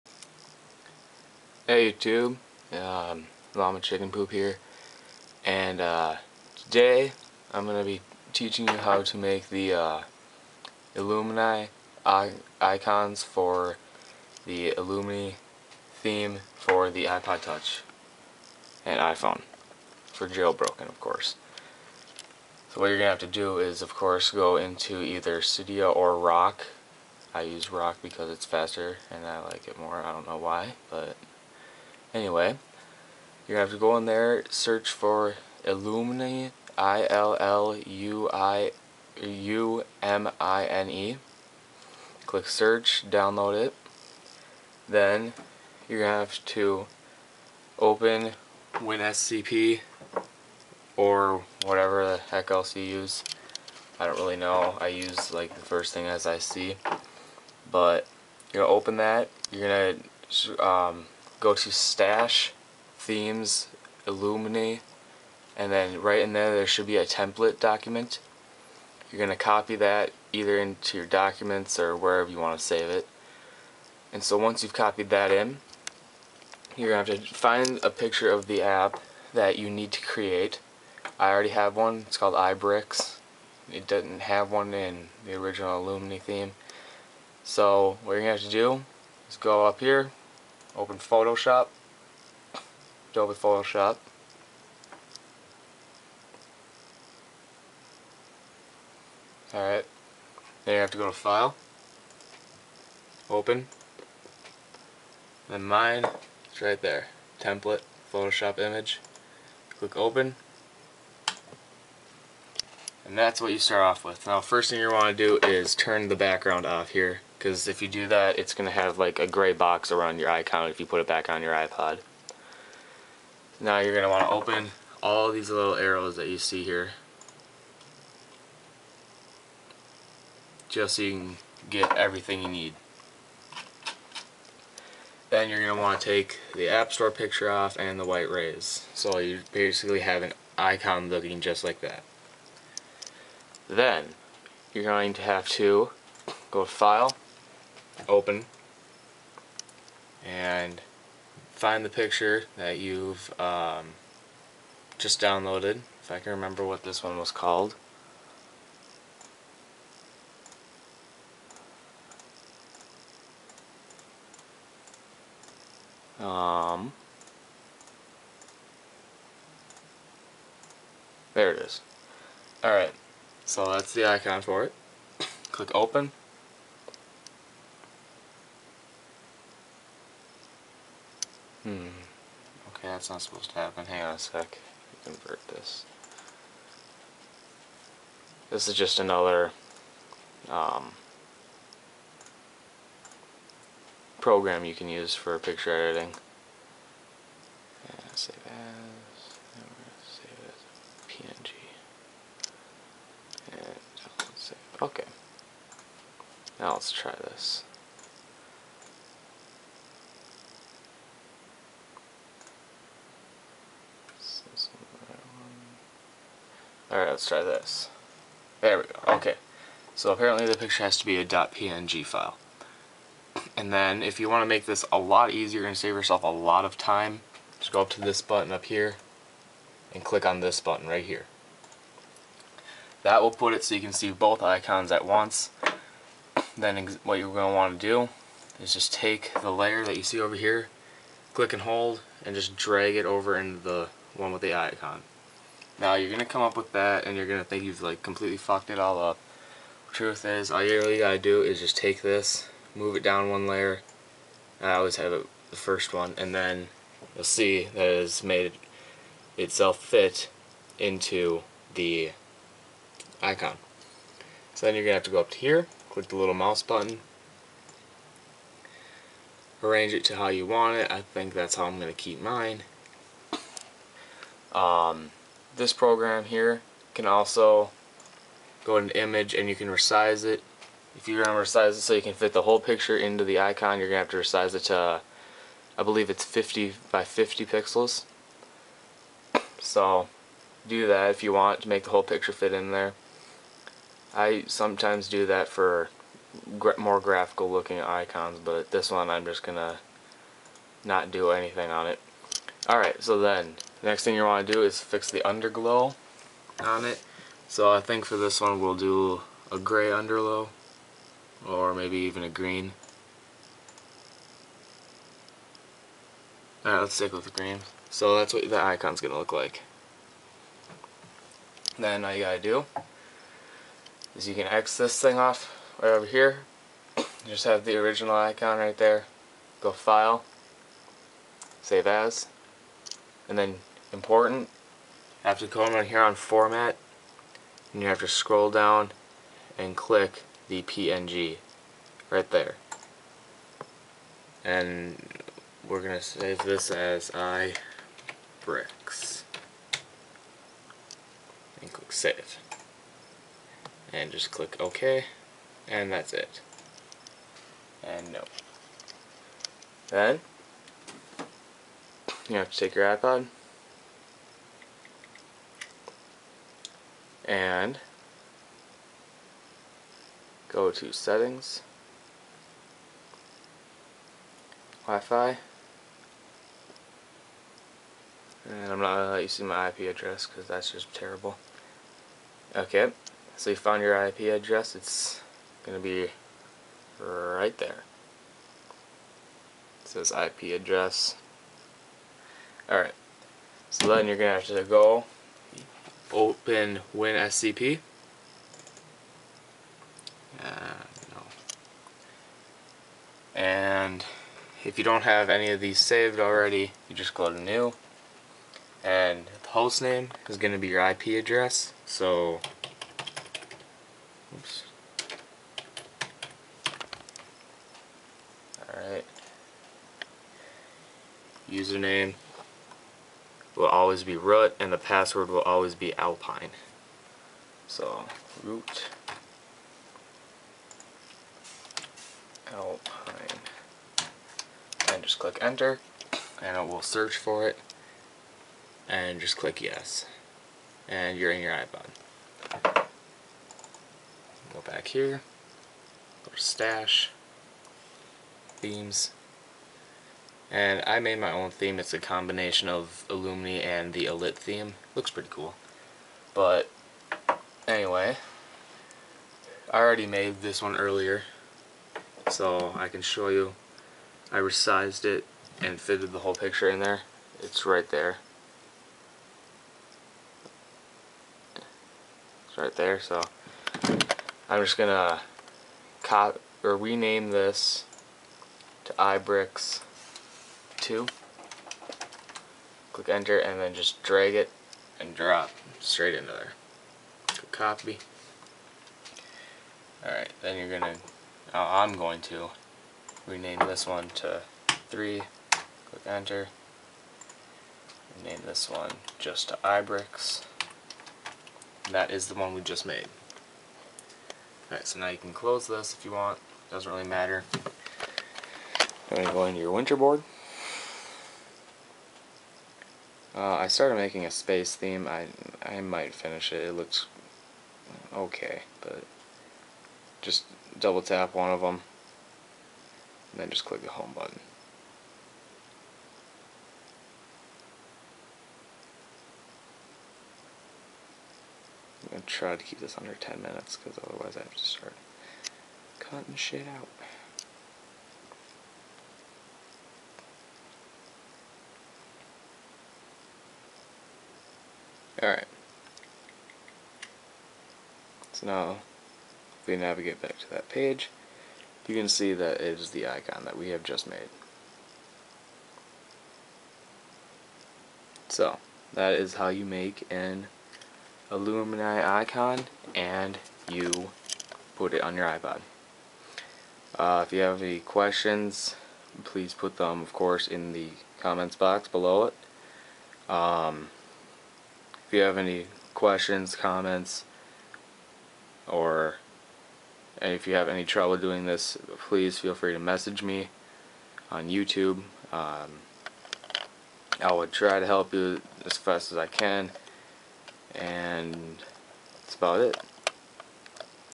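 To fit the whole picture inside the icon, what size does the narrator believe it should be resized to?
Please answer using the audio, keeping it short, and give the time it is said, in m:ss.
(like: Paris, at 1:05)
50 by 50 pixels, at 4:46.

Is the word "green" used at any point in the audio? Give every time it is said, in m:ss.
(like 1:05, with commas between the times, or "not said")
5:12, 5:17.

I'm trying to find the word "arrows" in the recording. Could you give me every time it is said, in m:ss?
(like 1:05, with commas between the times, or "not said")
2:05.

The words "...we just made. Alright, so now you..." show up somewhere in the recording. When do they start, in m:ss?
8:22.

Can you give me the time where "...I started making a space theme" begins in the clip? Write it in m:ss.
8:33.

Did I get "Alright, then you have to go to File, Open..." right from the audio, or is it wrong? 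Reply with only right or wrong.
right.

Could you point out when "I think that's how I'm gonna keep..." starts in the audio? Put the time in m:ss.
4:30.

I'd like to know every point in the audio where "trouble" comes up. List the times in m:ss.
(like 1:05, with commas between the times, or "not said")
9:40.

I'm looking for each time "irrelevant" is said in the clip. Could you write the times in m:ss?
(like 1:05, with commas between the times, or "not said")
not said.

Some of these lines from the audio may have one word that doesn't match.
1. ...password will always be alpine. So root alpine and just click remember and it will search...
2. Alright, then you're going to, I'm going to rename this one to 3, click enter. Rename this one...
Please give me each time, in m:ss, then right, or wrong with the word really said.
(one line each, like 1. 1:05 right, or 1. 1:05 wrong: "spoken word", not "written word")
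1. 7:04 wrong: "enter", not "remember"
2. 8:10 right.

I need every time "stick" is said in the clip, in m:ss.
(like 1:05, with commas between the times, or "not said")
5:16.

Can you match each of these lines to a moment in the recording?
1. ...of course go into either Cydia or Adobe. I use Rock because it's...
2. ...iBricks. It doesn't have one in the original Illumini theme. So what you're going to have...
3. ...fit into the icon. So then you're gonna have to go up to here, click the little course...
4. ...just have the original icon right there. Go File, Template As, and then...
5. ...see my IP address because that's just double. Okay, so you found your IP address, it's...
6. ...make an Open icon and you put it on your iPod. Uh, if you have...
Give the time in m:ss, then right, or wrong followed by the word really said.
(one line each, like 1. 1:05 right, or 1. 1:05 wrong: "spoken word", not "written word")
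1. 0:23 wrong: "Rock", not "Adobe"
2. 1:22 right
3. 4:19 wrong: "mouse", not "course"
4. 5:27 wrong: "Save", not "Template"
5. 6:19 wrong: "terrible", not "double"
6. 9:19 wrong: "Illumini", not "Open".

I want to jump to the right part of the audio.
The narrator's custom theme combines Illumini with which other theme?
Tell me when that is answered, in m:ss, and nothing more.
7:33.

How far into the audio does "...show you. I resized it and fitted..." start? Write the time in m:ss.
7:43.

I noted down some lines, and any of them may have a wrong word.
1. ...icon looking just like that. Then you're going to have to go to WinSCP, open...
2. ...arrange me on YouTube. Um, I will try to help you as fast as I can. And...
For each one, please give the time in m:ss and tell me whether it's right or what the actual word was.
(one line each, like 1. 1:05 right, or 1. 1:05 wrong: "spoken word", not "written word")
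1. 2:20 wrong: "File", not "WinSCP"
2. 9:42 wrong: "message", not "arrange".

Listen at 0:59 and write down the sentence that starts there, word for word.
You're gonna um, go to stash, themes, illuminate, and then right in there there should be a template document.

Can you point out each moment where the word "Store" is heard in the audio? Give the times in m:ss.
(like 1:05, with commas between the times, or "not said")
2:16.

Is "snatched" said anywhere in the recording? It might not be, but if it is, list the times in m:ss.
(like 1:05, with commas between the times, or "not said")
not said.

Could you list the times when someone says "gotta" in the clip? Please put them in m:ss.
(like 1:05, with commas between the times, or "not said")
4:10, 5:22.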